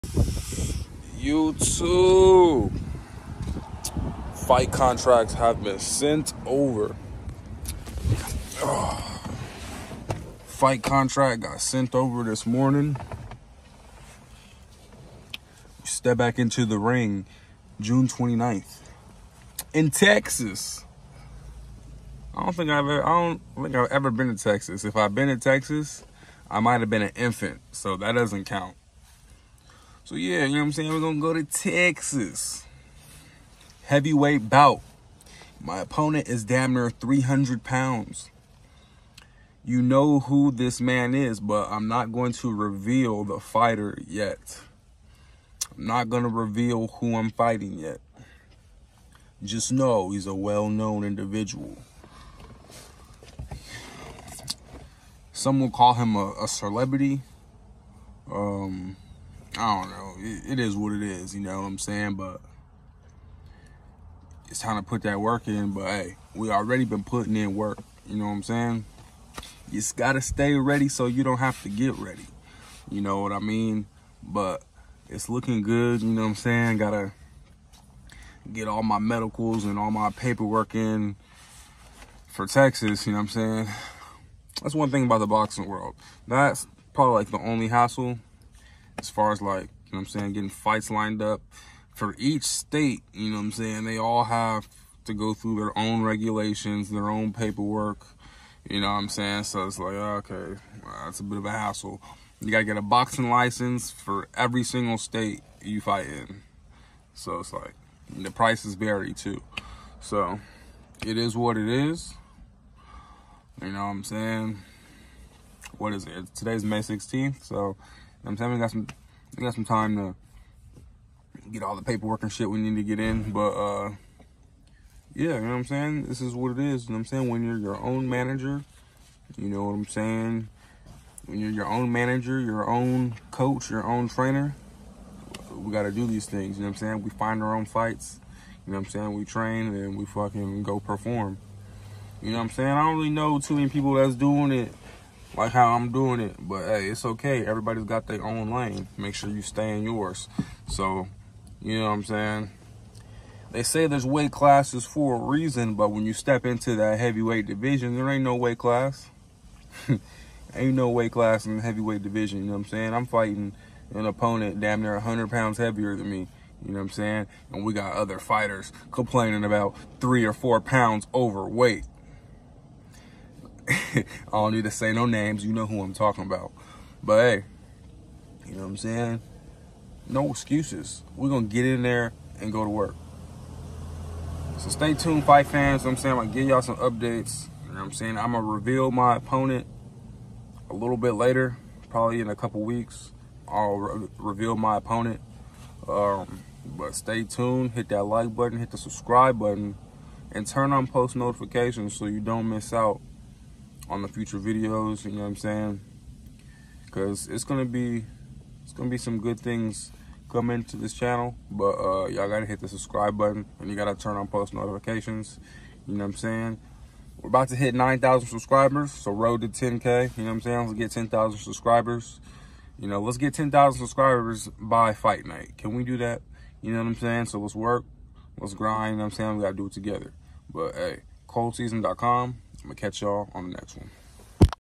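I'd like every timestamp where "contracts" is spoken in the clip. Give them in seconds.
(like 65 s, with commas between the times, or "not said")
4 s, 10 s.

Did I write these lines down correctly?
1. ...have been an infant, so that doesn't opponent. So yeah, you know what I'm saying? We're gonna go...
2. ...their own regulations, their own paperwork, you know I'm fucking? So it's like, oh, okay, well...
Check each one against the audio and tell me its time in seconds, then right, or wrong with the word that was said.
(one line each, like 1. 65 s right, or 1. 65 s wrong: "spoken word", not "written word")
1. 26 s wrong: "count", not "opponent"
2. 95 s wrong: "saying", not "fucking".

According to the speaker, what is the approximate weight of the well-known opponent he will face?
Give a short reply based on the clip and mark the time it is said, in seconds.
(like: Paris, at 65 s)
300 pounds, at 36 s.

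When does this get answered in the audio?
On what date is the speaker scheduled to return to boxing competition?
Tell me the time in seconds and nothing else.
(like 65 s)
17 s.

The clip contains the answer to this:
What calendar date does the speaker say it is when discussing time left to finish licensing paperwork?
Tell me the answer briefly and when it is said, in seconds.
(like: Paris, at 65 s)
May 16th, at 116 s.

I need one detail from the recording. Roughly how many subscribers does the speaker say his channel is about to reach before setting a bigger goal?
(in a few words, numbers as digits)
9,000.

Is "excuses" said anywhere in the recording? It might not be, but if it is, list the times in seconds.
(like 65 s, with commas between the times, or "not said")
180 s.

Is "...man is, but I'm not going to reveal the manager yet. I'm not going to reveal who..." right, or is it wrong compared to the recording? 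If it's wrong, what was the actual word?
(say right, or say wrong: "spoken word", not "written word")
wrong: "fighter", not "manager".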